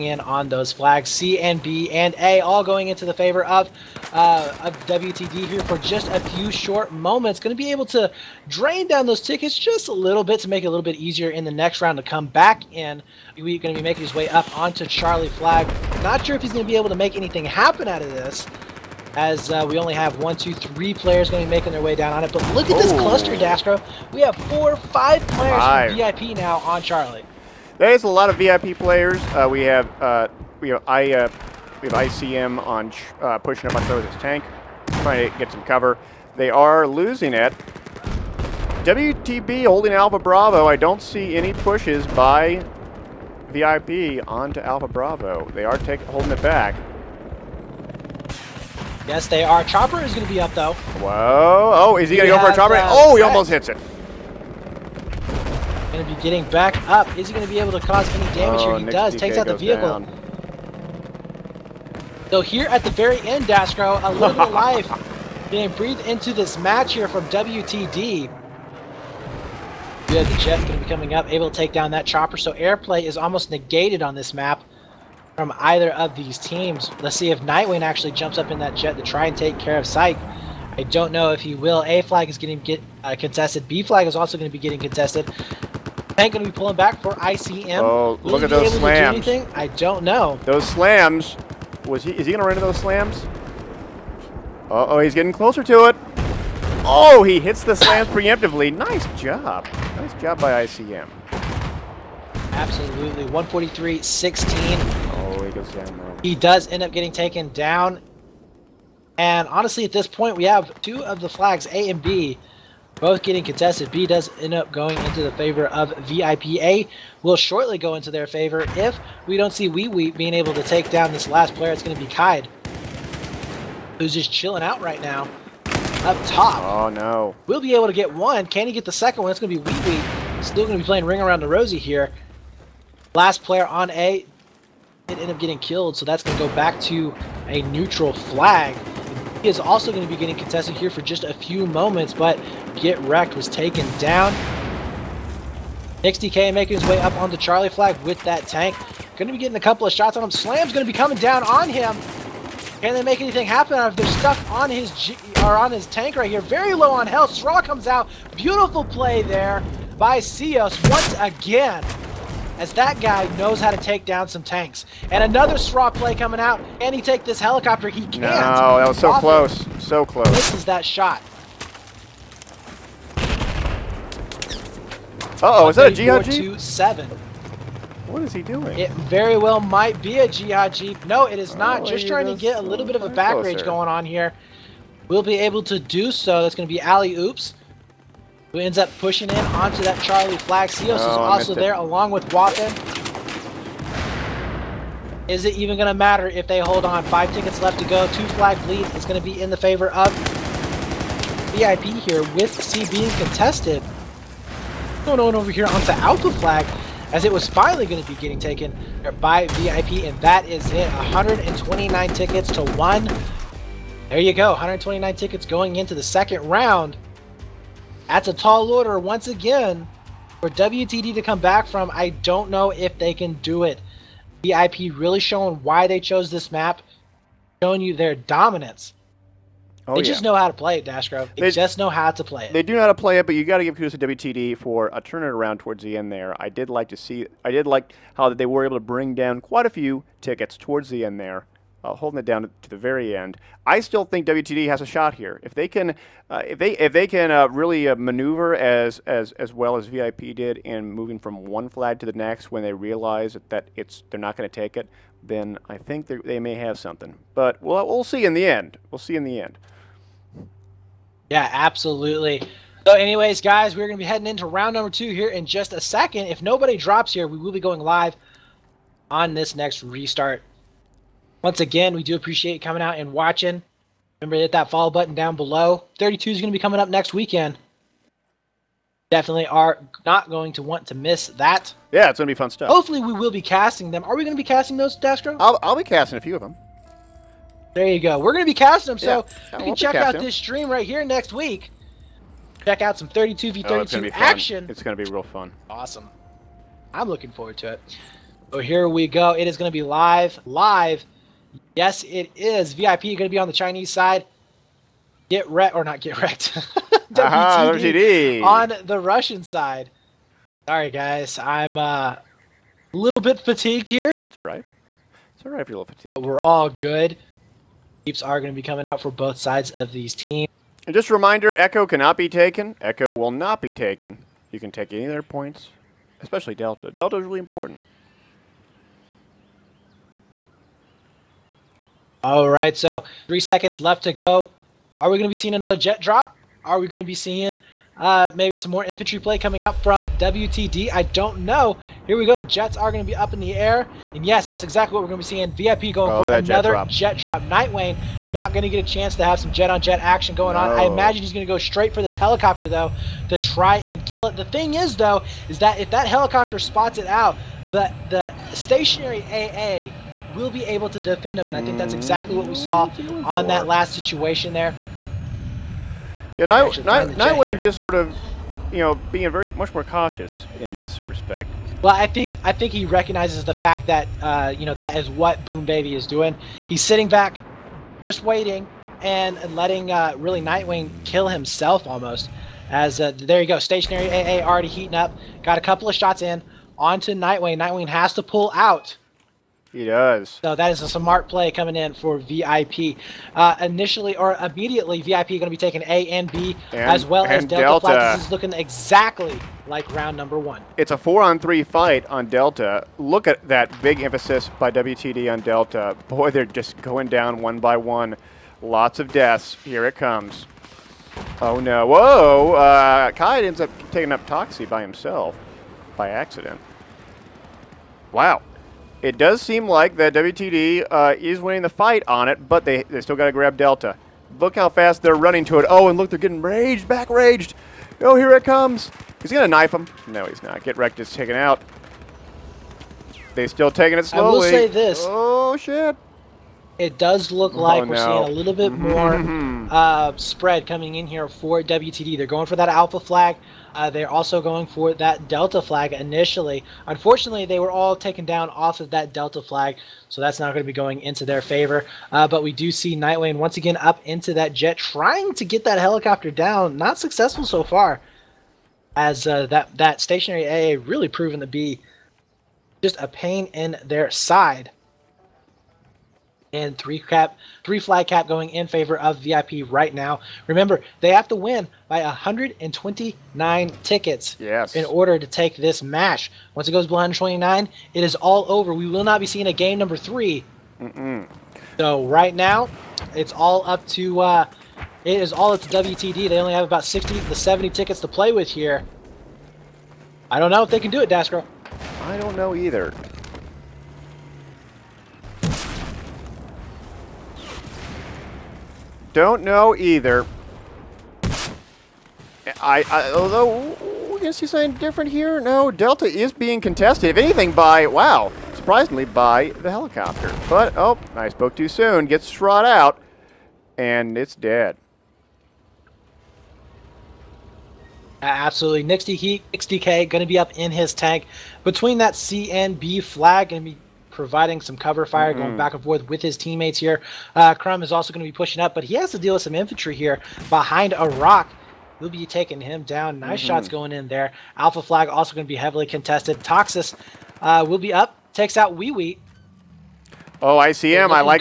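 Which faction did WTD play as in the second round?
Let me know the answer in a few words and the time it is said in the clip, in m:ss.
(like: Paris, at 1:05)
Russian, at 5:08.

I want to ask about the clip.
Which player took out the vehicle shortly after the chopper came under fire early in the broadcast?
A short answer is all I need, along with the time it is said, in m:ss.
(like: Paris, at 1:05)
DK, at 0:59.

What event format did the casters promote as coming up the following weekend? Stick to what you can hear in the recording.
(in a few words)
32v32.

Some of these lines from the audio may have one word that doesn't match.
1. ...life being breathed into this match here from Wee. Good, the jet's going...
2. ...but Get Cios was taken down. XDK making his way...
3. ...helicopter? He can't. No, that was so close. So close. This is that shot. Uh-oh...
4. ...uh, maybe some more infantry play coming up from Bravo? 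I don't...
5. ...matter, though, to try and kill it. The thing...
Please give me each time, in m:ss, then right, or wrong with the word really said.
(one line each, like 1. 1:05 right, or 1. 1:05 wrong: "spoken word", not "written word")
1. 1:04 wrong: "WTD", not "Wee"
2. 2:22 wrong: "Wrecked", not "Cios"
3. 2:47 right
4. 5:37 wrong: "WTD", not "Bravo"
5. 5:52 wrong: "helicopter", not "matter".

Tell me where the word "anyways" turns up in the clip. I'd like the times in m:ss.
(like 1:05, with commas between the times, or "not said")
4:22.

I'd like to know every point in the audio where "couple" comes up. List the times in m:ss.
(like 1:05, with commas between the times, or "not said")
2:29, 6:25.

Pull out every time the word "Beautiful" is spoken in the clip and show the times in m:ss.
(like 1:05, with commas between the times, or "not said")
2:38.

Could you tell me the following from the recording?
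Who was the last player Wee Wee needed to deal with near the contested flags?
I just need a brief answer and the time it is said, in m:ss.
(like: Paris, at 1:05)
Kaid, at 2:01.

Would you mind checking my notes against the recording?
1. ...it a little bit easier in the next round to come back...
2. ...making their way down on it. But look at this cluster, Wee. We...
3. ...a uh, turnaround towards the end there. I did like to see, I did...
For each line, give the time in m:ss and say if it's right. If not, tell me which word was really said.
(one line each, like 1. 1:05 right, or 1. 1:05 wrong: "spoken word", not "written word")
1. 0:10 right
2. 0:21 wrong: "Daskro", not "Wee"
3. 3:54 right.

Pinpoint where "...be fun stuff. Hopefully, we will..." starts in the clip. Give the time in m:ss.
4:42.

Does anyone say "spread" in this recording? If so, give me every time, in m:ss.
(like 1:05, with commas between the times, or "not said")
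7:20.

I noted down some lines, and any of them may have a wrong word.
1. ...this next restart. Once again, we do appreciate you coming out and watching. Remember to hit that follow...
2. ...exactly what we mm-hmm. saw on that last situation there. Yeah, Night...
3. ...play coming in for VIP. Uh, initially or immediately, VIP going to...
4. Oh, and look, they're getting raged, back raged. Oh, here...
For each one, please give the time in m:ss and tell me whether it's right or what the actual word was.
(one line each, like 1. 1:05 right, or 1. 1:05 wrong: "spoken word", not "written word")
1. 4:29 right
2. 6:01 right
3. 6:31 right
4. 7:05 right.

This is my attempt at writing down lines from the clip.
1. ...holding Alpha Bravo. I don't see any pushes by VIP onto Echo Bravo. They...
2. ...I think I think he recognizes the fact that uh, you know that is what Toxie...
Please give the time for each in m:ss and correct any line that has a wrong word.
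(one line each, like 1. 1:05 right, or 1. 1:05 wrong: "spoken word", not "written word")
1. 0:39 wrong: "Alpha", not "Echo"
2. 6:11 wrong: "Boom", not "Toxie".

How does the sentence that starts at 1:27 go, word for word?
Oh, will look at those slams!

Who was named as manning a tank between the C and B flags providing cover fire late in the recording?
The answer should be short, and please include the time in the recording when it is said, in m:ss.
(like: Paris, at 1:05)
Nixty Heat, at 8:38.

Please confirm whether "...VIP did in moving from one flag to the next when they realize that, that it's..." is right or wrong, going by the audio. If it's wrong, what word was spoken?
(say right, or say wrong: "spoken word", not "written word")
right.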